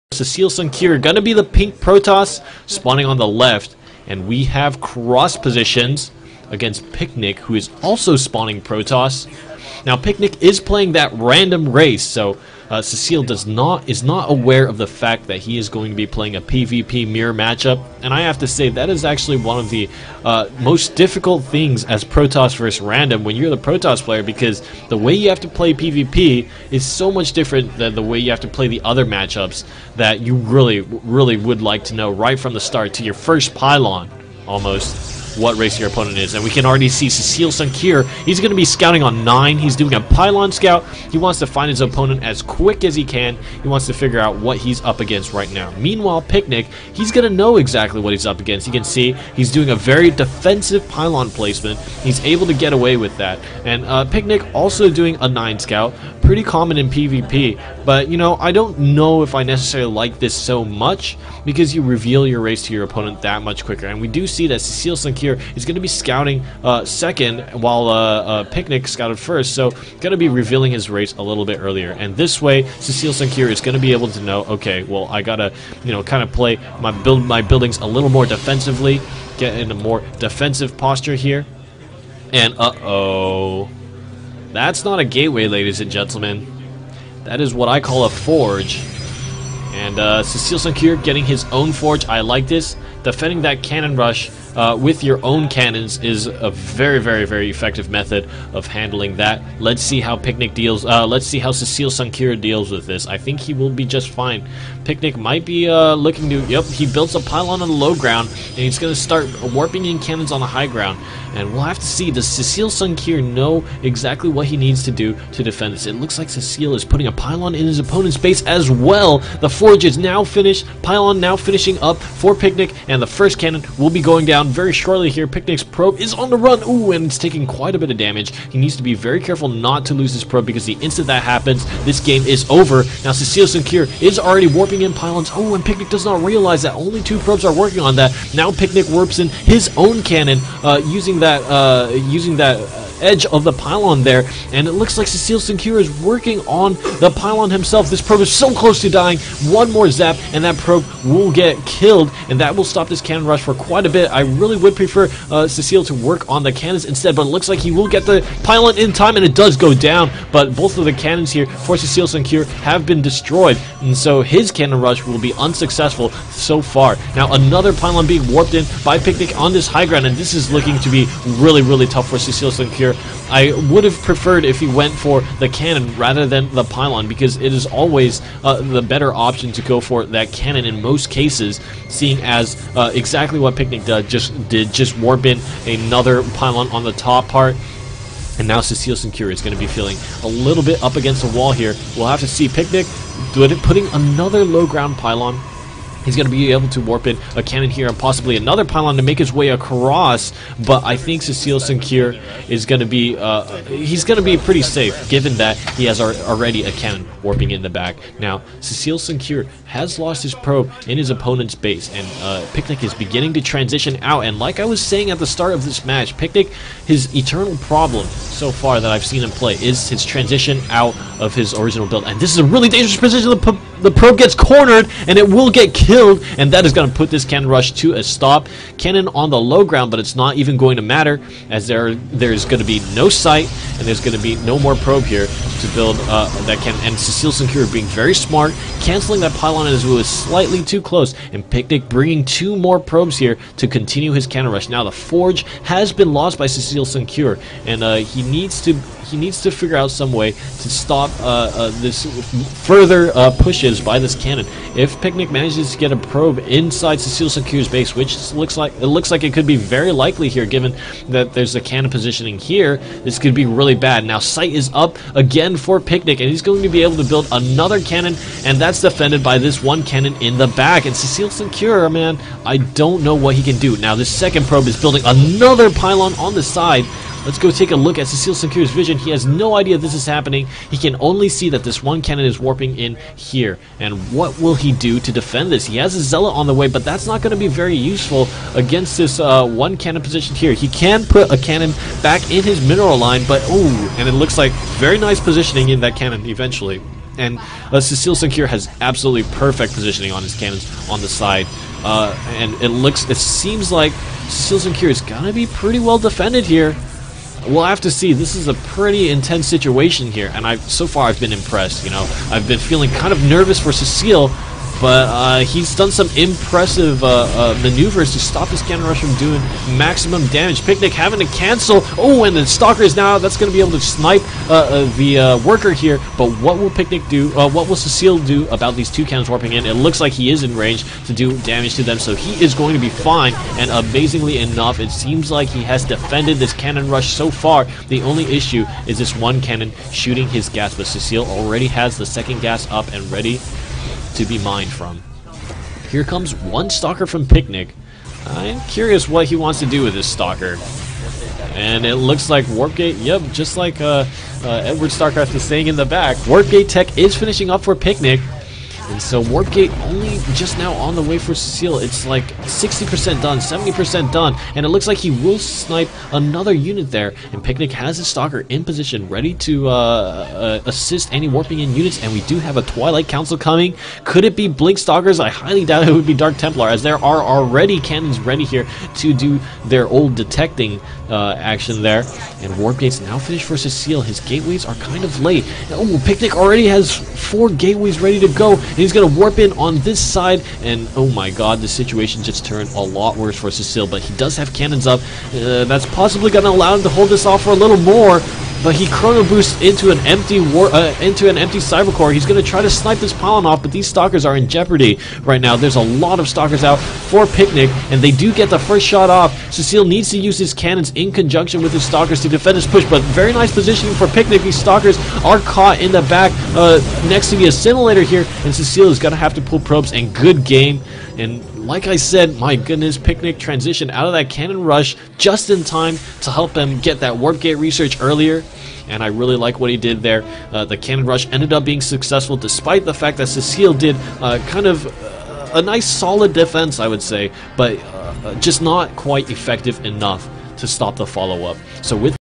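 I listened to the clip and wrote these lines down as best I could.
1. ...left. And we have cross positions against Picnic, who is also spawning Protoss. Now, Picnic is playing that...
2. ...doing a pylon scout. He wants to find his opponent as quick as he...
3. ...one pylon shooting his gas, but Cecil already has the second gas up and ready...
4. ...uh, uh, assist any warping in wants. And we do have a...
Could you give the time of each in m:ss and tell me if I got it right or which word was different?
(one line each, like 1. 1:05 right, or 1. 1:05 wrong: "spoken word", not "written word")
1. 0:03 right
2. 0:39 right
3. 5:39 wrong: "cannon", not "pylon"
4. 6:09 wrong: "units", not "wants".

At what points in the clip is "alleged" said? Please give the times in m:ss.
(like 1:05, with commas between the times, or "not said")
not said.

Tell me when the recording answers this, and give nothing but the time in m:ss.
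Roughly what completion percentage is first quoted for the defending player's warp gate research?
6:02.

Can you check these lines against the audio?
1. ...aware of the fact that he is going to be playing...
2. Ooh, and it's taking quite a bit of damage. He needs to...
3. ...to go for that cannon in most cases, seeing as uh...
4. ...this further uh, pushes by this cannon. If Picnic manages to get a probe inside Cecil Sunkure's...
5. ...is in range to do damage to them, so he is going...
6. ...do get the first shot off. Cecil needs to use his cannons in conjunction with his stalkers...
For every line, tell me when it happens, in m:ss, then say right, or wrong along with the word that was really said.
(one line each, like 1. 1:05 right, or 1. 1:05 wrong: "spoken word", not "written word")
1. 0:14 right
2. 2:06 right
3. 2:59 right
4. 4:11 right
5. 5:30 right
6. 6:48 right.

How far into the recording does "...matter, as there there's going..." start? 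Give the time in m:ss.
3:50.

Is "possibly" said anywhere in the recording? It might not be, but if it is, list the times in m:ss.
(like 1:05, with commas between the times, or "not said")
3:17, 6:35.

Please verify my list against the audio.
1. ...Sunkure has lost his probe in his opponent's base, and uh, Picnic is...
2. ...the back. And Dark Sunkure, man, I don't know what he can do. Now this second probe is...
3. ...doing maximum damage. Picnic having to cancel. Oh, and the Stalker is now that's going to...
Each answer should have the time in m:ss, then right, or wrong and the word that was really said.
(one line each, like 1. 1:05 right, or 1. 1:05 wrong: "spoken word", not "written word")
1. 3:28 right
2. 4:30 wrong: "Cecil", not "Dark"
3. 5:19 right.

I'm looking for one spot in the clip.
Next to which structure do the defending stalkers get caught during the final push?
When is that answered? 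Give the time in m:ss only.
6:57.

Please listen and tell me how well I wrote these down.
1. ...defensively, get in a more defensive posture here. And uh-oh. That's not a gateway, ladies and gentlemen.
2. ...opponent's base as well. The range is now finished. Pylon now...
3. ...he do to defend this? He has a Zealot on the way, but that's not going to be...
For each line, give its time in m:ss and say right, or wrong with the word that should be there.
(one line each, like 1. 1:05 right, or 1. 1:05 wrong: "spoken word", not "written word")
1. 1:18 right
2. 1:57 wrong: "forge", not "range"
3. 4:44 right.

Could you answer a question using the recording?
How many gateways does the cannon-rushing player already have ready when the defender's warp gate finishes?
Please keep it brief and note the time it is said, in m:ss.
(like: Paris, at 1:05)
4, at 6:27.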